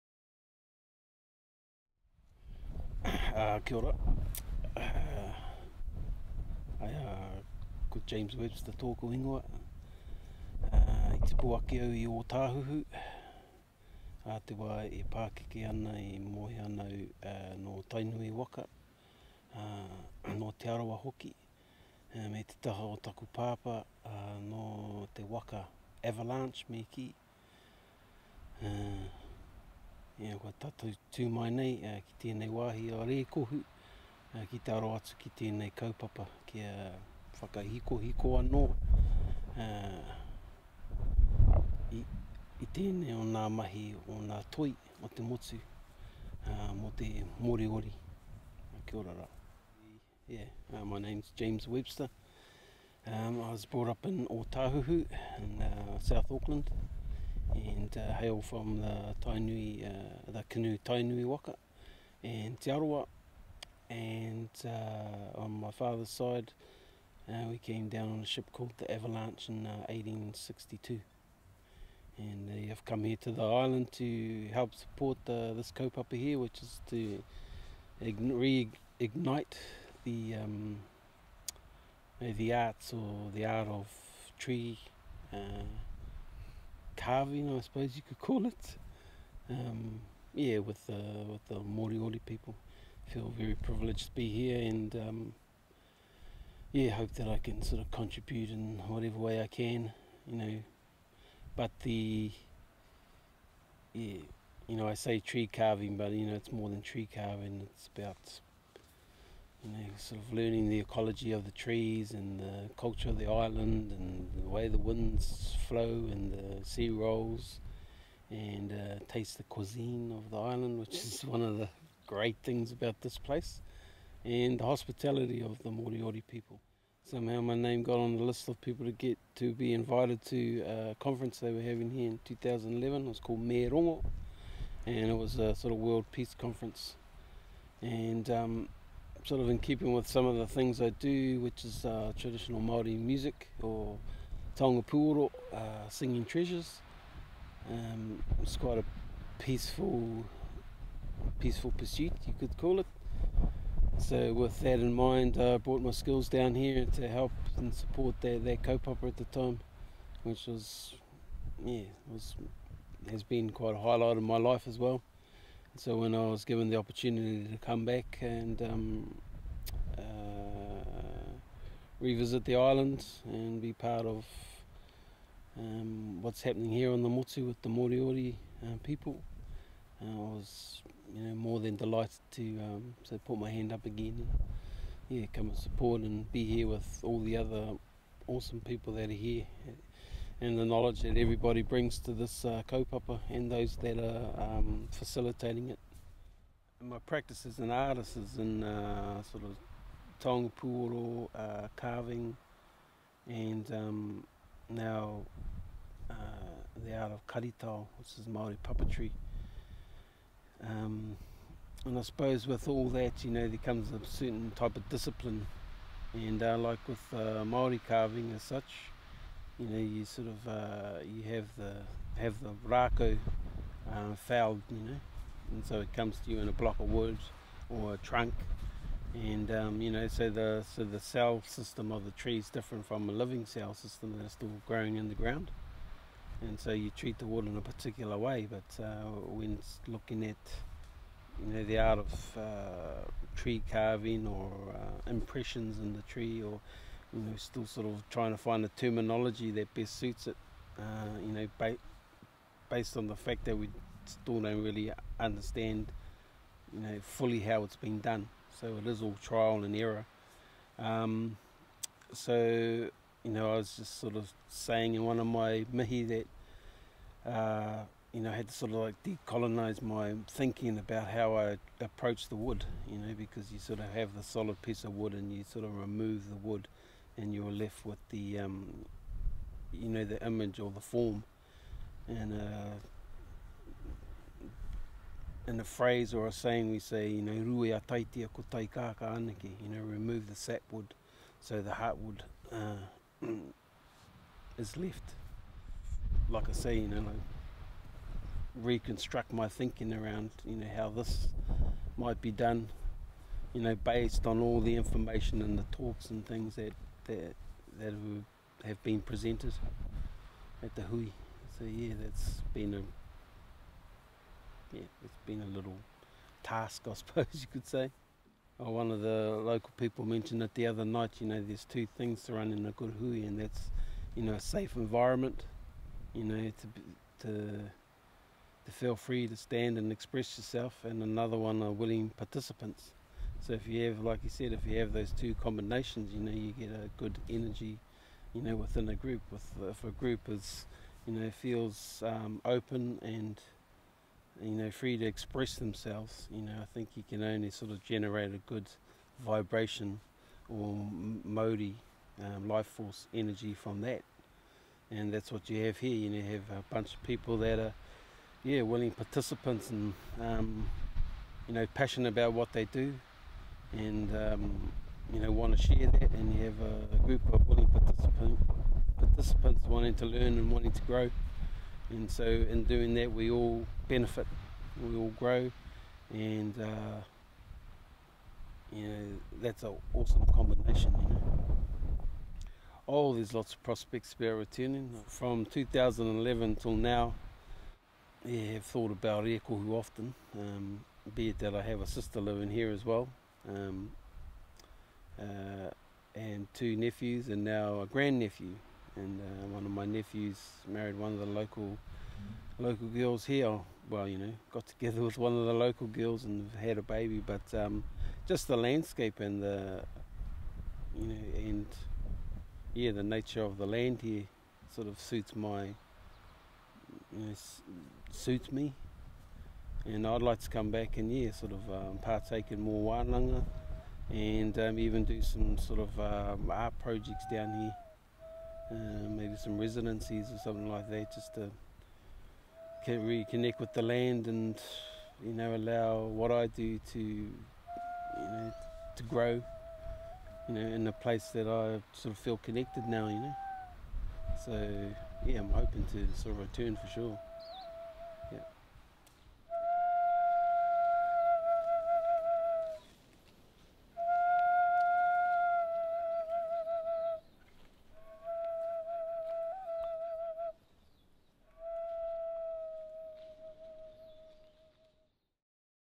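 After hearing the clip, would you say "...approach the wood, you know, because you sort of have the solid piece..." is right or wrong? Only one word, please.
right.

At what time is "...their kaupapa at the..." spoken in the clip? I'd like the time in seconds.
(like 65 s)
158 s.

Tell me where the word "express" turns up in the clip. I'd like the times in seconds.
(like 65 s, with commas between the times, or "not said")
329 s, 345 s.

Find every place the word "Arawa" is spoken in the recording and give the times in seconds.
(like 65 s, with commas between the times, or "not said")
20 s, 62 s.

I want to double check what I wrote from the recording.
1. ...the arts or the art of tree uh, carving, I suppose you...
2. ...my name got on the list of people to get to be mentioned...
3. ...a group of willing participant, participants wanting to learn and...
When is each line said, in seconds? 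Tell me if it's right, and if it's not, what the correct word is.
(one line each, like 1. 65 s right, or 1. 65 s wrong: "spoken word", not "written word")
1. 82 s right
2. 127 s wrong: "invited", not "mentioned"
3. 366 s right.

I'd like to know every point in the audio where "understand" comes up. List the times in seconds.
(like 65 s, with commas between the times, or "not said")
255 s.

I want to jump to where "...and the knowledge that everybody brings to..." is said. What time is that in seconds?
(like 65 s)
190 s.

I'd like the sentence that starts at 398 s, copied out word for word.
And uh, one of my nephews married one of the local local girls here.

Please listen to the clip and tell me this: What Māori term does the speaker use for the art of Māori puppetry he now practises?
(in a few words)
karitao.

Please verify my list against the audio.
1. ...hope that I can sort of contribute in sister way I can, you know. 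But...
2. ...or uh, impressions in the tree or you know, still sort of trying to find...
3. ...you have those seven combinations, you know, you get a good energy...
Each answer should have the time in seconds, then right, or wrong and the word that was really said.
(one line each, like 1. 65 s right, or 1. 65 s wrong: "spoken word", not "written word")
1. 96 s wrong: "whatever", not "sister"
2. 244 s right
3. 334 s wrong: "two", not "seven".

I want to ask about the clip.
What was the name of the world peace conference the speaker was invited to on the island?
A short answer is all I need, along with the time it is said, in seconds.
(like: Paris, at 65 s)
Me Rongo, at 133 s.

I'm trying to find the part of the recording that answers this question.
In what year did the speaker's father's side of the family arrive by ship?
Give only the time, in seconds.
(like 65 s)
69 s.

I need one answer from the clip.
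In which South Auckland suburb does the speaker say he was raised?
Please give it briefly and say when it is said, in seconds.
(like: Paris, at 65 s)
Otahuhu, at 54 s.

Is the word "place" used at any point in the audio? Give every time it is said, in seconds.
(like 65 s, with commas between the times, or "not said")
123 s, 440 s.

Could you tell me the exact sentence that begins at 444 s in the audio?
So yeah, I'm hoping to sort of return for sure.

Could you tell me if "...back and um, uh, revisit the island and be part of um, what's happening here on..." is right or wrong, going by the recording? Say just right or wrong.
right.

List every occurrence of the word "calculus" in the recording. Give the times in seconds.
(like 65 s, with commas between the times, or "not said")
not said.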